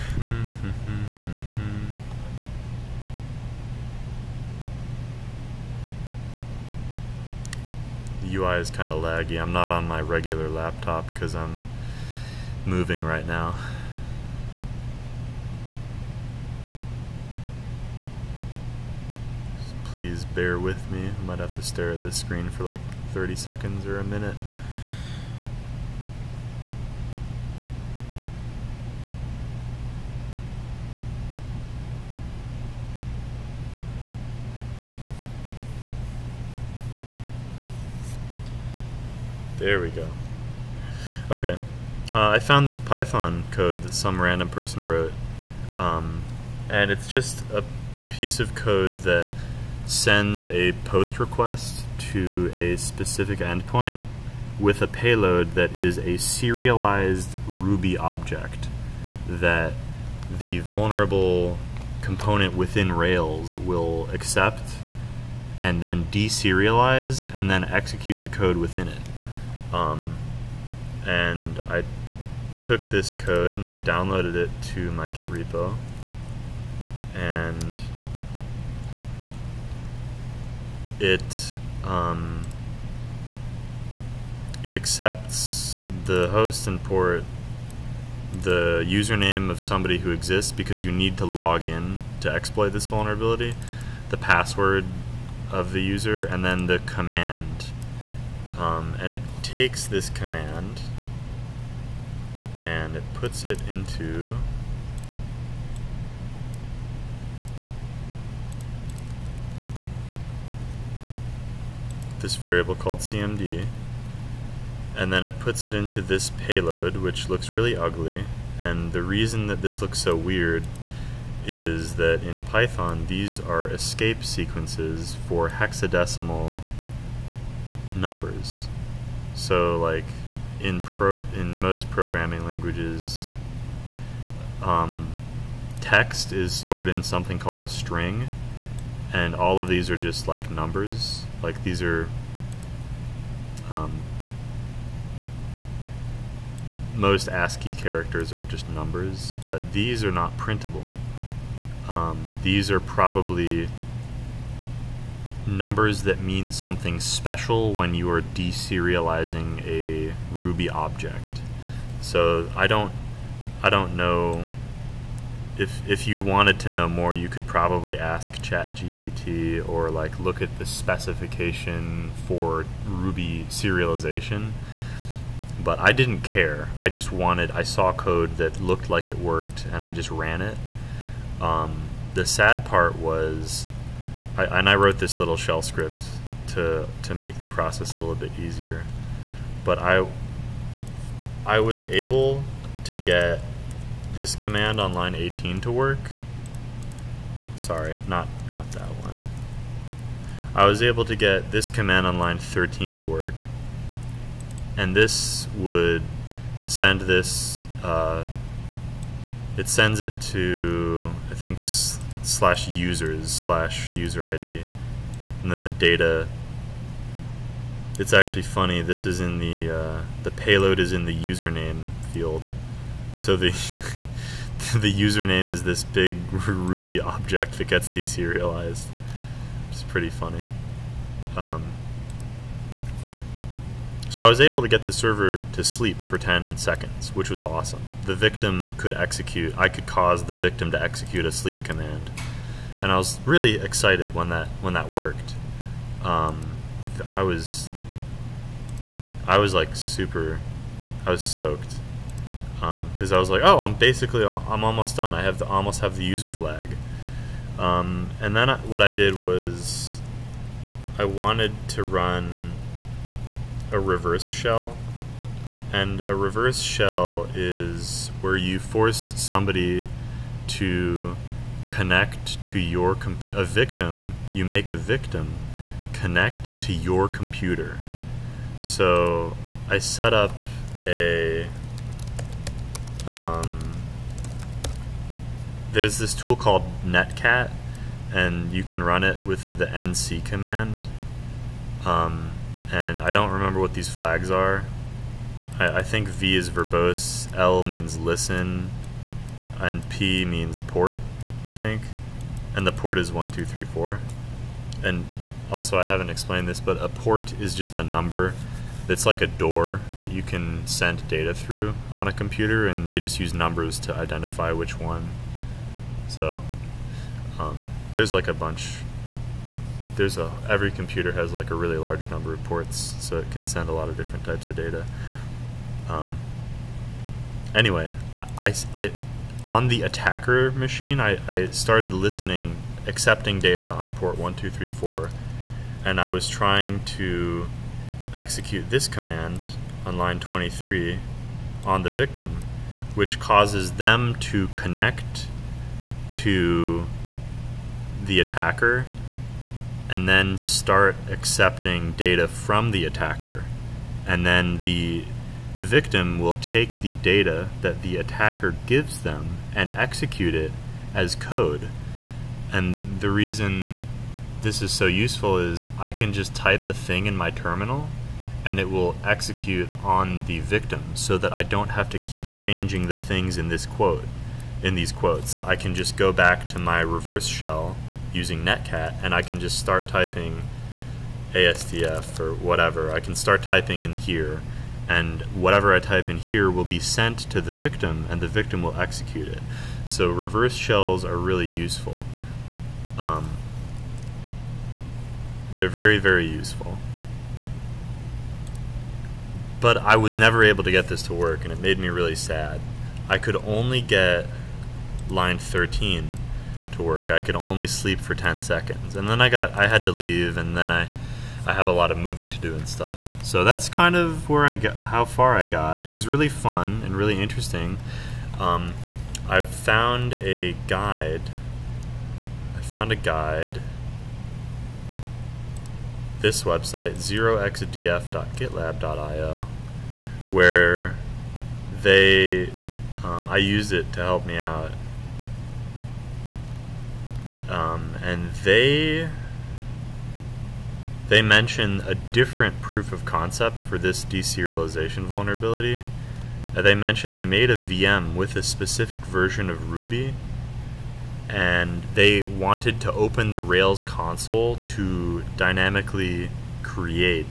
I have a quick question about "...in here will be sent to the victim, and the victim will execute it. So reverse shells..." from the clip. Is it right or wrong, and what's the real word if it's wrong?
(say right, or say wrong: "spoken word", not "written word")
right.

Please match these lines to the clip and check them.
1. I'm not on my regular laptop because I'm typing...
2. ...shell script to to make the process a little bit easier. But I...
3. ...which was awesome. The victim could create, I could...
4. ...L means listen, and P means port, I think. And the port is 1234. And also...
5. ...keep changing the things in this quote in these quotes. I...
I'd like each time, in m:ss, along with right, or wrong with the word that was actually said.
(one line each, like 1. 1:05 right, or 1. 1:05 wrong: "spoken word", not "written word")
1. 0:09 wrong: "moving", not "typing"
2. 3:05 right
3. 3:57 wrong: "execute", not "create"
4. 4:57 right
5. 6:11 right.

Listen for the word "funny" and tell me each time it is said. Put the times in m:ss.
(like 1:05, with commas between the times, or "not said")
3:38, 3:50.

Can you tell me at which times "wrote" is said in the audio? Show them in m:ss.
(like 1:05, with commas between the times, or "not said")
0:44, 3:04.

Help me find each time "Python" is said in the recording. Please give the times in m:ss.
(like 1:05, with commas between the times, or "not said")
0:42, 2:02.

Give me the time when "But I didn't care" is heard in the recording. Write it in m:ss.
2:55.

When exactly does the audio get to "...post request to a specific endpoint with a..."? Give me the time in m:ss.
0:50.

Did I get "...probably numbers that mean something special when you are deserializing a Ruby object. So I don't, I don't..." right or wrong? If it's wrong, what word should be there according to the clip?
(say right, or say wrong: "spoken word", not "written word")
right.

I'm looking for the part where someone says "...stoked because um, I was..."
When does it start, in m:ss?
4:11.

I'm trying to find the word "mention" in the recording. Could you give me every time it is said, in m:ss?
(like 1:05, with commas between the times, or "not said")
7:21, 7:26.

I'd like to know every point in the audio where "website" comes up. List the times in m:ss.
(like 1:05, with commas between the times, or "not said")
7:06.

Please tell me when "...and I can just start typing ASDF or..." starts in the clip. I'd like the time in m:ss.
6:19.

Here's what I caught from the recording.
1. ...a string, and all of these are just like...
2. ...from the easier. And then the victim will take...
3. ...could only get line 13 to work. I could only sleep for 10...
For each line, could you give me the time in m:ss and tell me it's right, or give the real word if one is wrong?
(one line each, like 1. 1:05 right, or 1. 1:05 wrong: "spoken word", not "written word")
1. 2:17 right
2. 5:52 wrong: "attacker", not "easier"
3. 6:43 right.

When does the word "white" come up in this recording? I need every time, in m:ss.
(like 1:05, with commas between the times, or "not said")
not said.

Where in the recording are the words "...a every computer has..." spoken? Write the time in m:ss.
5:20.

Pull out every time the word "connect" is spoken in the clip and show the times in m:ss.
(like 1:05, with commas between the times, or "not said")
4:31, 4:35, 5:44.